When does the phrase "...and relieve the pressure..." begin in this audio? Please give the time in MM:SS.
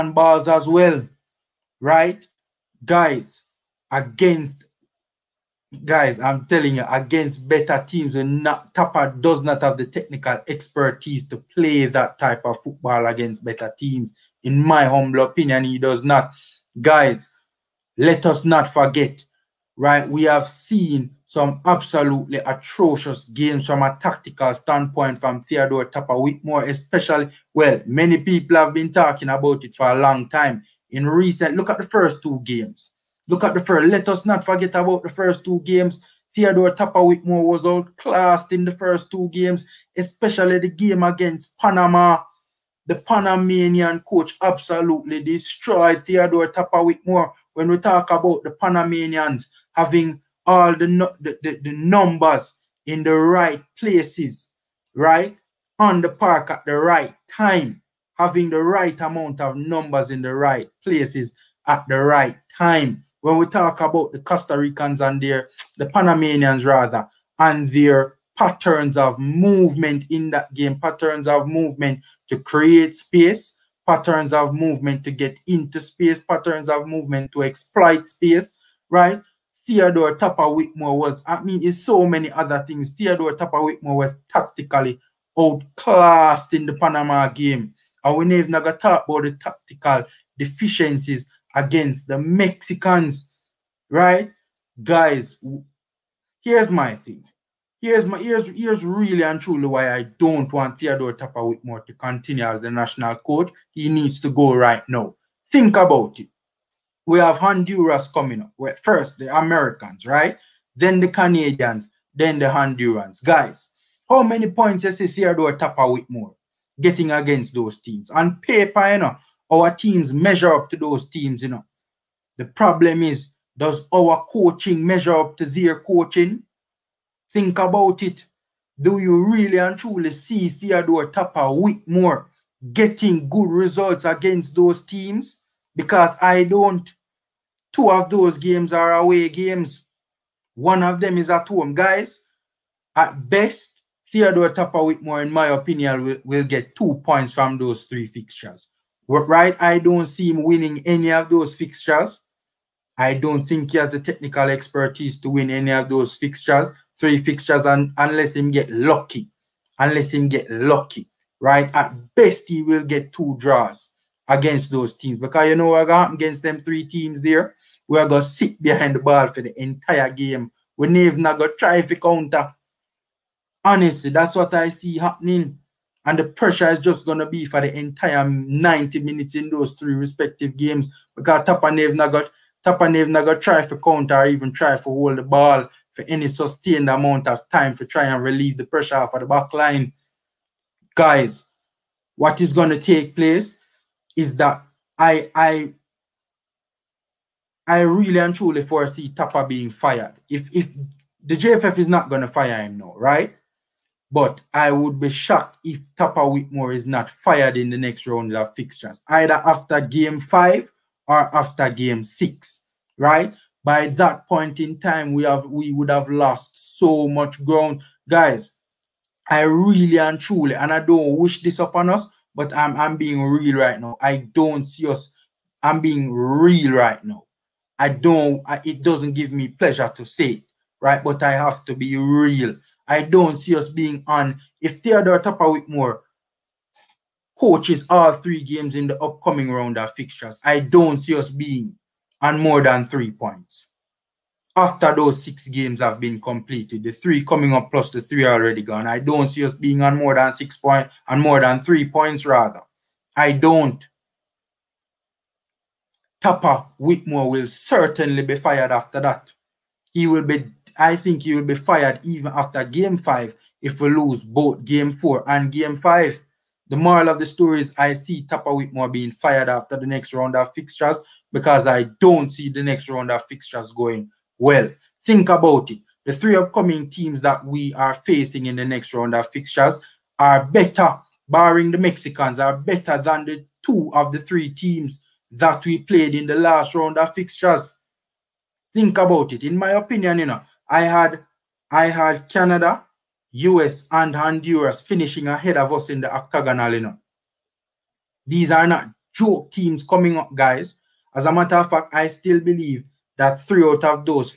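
03:08.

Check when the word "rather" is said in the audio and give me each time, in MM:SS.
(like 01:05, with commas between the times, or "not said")
01:06, 04:12.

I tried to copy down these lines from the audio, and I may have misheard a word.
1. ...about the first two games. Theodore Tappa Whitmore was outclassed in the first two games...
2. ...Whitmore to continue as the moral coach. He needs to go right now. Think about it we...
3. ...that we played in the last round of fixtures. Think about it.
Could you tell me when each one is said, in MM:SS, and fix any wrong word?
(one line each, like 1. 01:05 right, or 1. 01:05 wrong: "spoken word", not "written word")
1. 00:34 right
2. 01:41 wrong: "national", not "moral"
3. 04:45 right.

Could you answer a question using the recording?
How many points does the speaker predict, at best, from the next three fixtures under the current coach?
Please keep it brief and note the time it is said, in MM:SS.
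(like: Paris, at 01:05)
2, at 02:26.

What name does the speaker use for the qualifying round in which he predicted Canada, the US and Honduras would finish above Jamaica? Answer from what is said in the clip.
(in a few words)
the octagonal.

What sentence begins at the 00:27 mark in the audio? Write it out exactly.
Well, many people have been talking about it for a long time.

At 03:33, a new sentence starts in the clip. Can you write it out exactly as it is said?
By that point in time, we have we would have lost so much ground.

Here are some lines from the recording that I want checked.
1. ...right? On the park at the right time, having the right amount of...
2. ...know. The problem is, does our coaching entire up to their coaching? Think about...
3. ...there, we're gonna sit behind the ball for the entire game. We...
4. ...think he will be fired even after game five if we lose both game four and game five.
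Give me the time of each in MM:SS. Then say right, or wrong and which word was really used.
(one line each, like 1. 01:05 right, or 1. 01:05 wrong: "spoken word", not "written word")
1. 00:54 right
2. 02:01 wrong: "measure", not "entire"
3. 02:47 right
4. 04:20 right.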